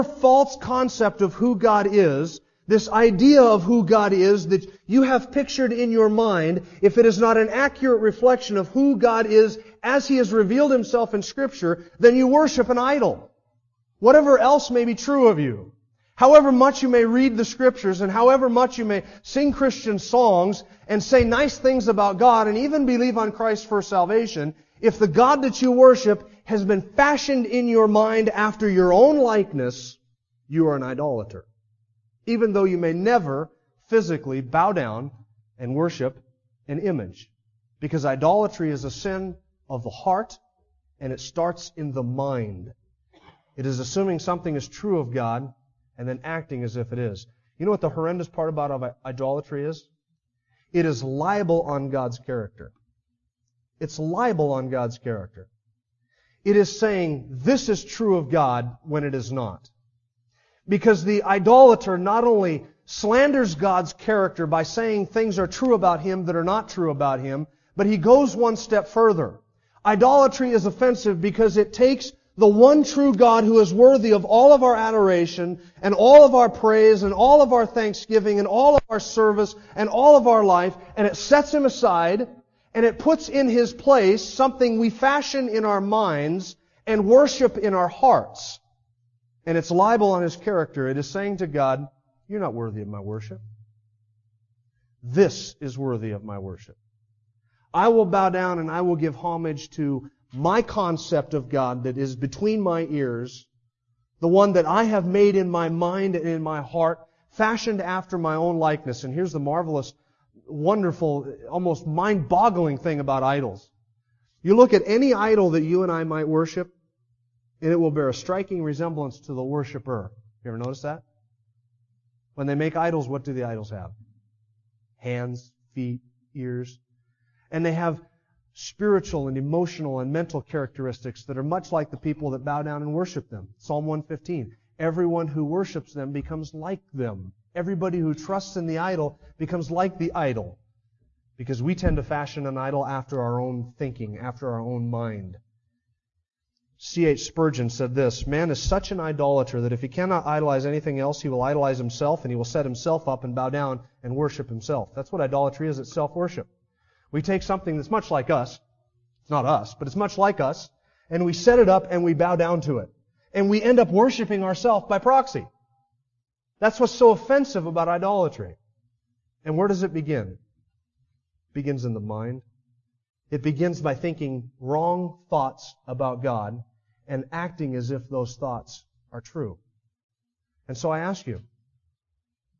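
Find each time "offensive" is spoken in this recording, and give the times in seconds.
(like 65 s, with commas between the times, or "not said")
70 s, 167 s.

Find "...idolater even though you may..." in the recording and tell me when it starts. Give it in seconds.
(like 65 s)
30 s.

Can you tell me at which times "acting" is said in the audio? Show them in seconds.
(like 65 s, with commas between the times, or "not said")
46 s, 177 s.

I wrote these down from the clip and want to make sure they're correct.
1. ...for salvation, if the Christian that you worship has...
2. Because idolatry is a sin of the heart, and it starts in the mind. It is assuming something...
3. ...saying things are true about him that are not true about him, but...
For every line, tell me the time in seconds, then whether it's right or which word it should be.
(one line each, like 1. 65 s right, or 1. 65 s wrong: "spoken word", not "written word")
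1. 23 s wrong: "God", not "Christian"
2. 37 s right
3. 64 s right.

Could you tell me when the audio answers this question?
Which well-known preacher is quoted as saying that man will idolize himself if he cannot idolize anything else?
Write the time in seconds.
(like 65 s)
146 s.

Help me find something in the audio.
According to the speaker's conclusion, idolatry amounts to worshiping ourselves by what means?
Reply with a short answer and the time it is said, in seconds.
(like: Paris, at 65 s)
by proxy, at 164 s.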